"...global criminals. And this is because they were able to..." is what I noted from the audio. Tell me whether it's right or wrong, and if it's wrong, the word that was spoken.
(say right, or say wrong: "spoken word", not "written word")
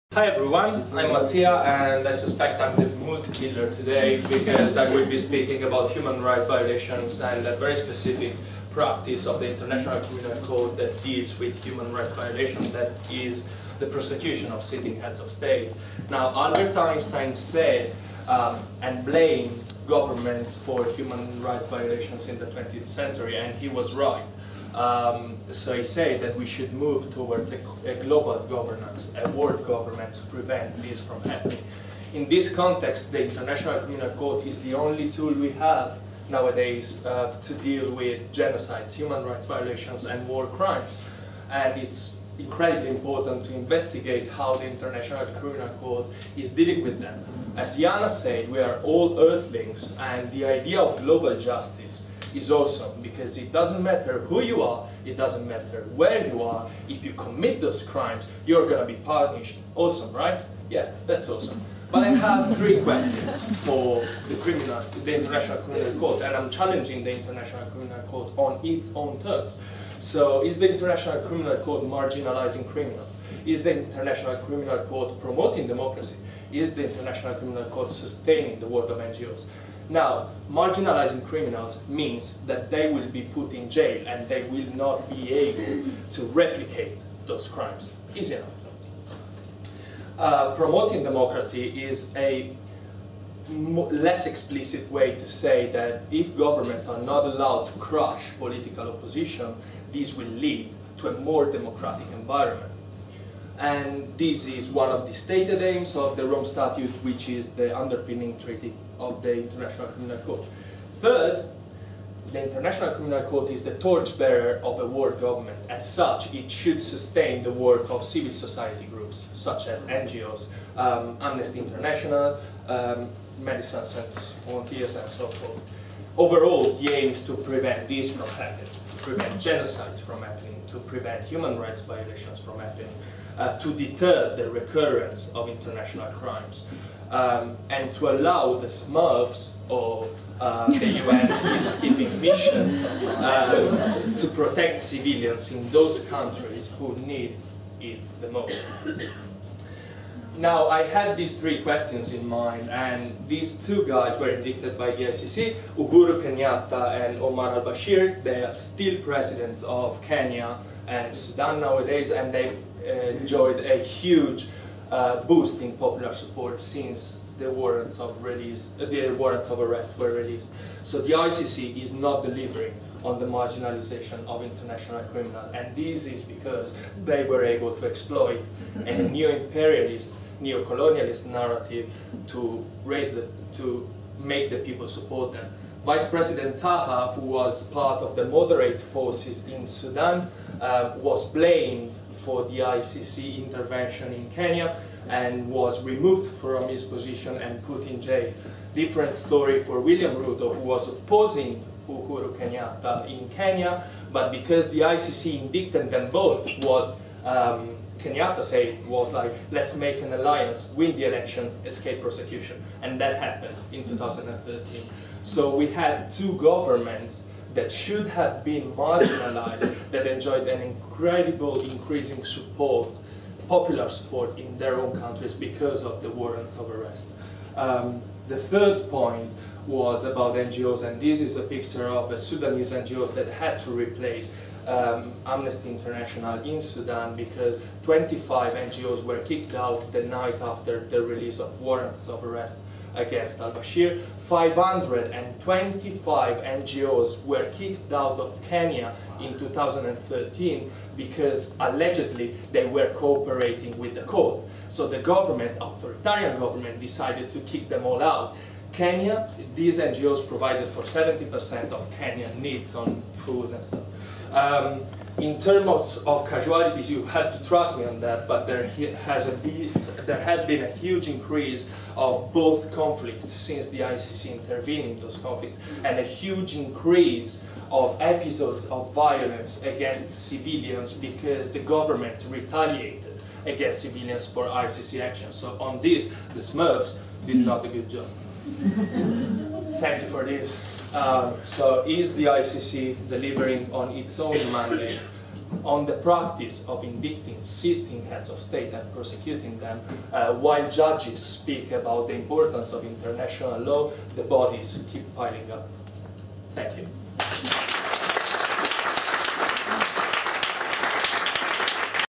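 wrong: "international", not "global".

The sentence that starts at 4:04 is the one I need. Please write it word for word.
525 NGOs were kicked out of Kenya in 2013 because allegedly they were cooperating with the court.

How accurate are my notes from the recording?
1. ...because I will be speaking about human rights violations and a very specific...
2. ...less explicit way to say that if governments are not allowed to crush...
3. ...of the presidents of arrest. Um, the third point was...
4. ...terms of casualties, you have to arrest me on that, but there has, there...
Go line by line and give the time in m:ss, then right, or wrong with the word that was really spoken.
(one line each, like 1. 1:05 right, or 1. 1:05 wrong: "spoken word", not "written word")
1. 0:04 right
2. 1:33 right
3. 3:45 wrong: "warrants", not "presidents"
4. 4:25 wrong: "trust", not "arrest".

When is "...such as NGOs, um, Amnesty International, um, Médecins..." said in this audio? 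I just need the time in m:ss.
1:59.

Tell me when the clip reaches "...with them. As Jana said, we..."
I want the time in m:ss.
0:46.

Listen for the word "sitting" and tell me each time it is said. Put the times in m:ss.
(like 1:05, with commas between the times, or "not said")
0:14, 4:57.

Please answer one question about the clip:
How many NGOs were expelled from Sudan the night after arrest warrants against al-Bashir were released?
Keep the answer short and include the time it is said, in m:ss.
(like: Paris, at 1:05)
25, at 3:57.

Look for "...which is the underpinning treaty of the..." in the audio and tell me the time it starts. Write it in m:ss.
1:47.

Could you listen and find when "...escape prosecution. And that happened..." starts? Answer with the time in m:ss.
3:31.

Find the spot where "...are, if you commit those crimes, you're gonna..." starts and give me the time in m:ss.
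0:56.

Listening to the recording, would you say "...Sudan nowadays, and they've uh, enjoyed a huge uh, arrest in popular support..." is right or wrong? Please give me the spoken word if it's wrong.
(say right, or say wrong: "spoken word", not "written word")
wrong: "boost", not "arrest".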